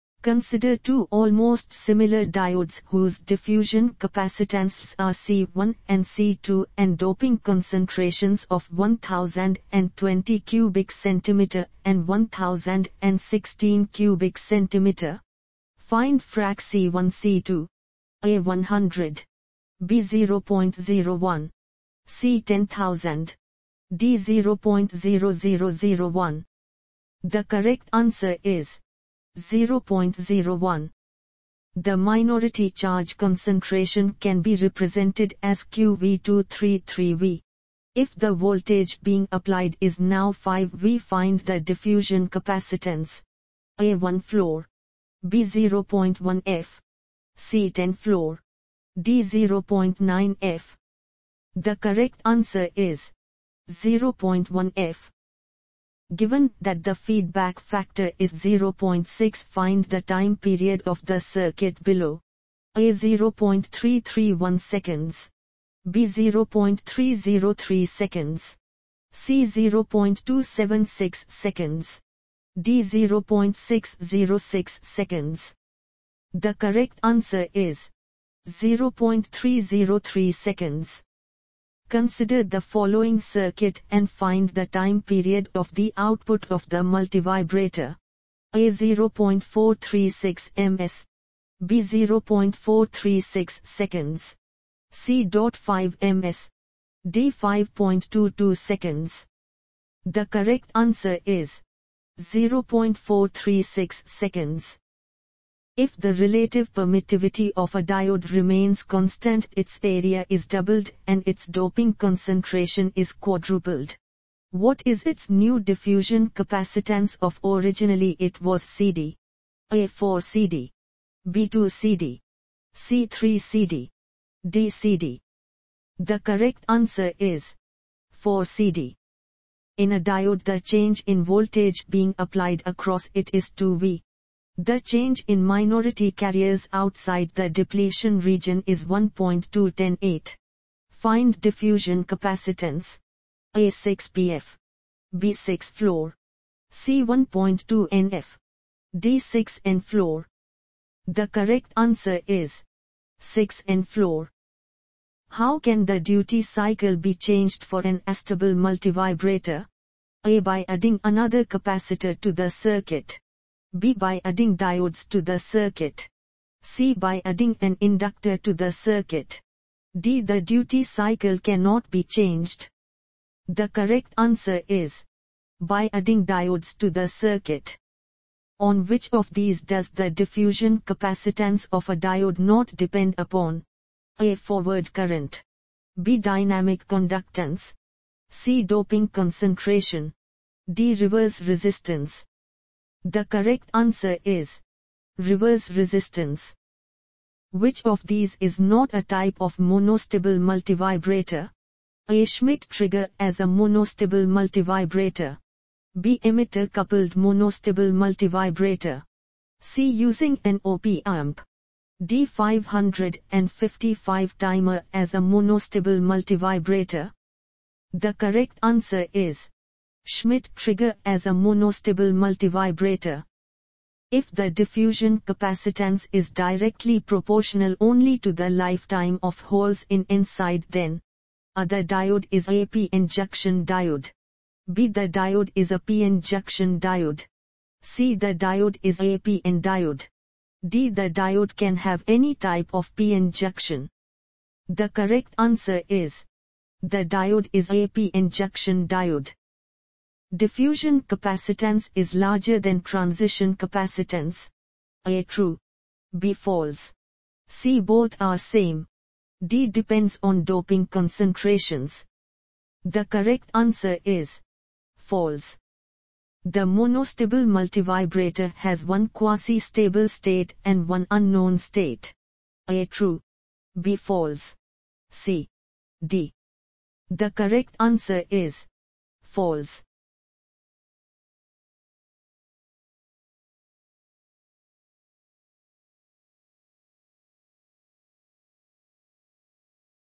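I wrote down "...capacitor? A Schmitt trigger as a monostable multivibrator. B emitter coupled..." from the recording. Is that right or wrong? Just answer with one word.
wrong.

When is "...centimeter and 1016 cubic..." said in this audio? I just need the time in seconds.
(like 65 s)
10 s.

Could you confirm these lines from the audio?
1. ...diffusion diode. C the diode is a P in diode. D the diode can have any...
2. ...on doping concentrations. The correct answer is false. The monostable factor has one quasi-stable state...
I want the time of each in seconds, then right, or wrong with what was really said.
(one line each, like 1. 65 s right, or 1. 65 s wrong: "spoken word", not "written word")
1. 236 s wrong: "injection", not "diffusion"
2. 260 s wrong: "multivibrator", not "factor".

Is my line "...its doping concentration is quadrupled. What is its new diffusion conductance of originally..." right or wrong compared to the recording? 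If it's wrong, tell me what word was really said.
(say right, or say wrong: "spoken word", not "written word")
wrong: "capacitance", not "conductance".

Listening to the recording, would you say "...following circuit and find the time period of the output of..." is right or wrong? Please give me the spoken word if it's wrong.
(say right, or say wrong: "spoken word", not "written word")
right.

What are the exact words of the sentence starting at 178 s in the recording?
On which of these does the diffusion capacitance of a diode not depend upon?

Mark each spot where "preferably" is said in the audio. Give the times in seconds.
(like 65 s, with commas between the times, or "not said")
not said.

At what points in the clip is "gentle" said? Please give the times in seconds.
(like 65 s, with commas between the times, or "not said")
not said.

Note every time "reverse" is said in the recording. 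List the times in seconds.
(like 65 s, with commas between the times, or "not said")
190 s, 195 s.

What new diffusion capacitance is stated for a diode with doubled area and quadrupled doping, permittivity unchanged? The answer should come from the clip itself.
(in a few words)
4 CD.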